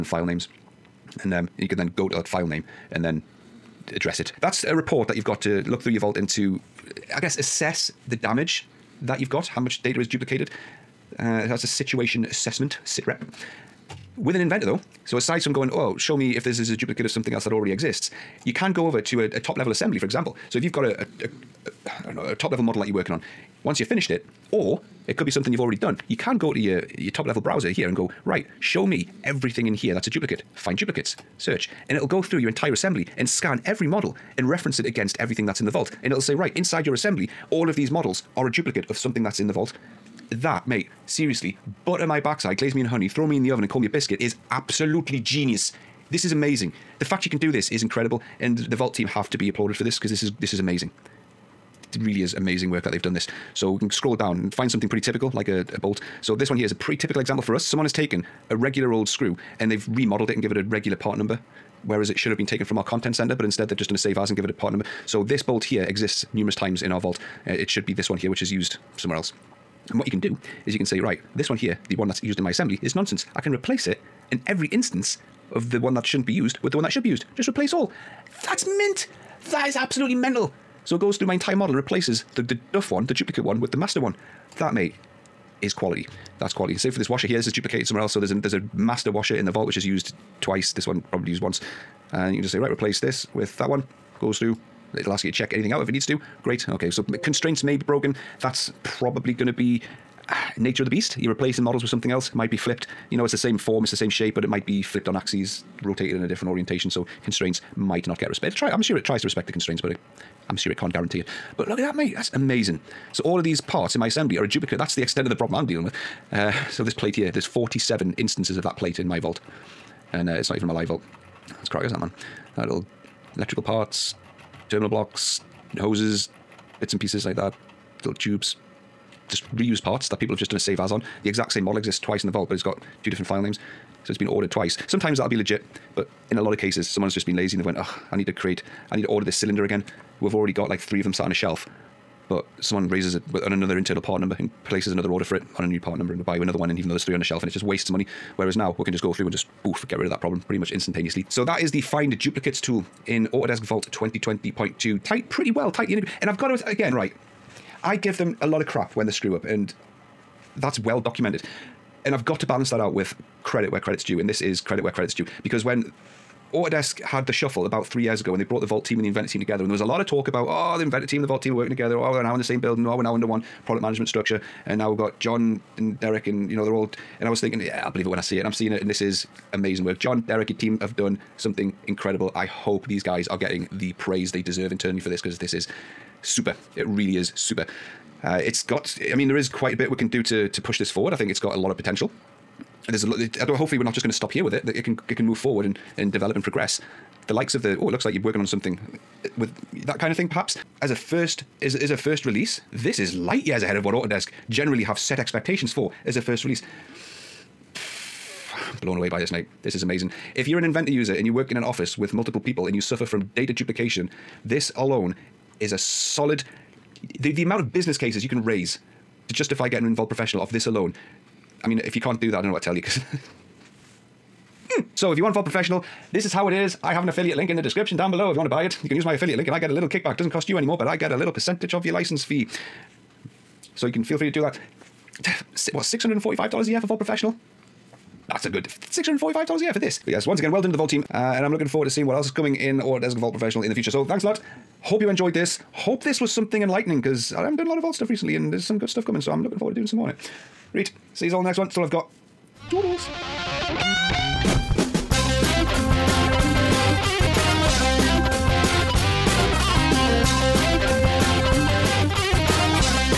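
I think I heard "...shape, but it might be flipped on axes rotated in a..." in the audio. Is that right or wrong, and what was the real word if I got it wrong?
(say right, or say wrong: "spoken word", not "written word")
right.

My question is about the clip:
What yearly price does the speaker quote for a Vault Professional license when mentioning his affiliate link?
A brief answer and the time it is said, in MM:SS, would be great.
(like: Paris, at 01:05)
$645, at 03:58.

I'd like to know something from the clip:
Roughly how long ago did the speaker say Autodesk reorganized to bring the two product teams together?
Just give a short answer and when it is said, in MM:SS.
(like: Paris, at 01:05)
About three years, at 02:47.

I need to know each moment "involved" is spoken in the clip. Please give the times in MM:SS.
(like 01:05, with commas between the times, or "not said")
03:39, 03:45.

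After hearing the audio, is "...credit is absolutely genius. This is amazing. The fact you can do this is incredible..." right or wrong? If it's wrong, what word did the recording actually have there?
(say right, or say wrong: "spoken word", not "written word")
wrong: "biscuit", not "credit".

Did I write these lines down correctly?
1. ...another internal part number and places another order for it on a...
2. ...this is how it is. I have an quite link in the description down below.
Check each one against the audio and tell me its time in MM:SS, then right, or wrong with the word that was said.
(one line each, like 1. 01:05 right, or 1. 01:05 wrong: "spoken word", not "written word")
1. 02:23 right
2. 03:46 wrong: "affiliate", not "quite".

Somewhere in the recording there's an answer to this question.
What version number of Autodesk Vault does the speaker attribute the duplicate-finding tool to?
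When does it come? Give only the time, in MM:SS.
02:33.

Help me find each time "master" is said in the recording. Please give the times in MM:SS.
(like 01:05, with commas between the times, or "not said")
01:23, 01:28.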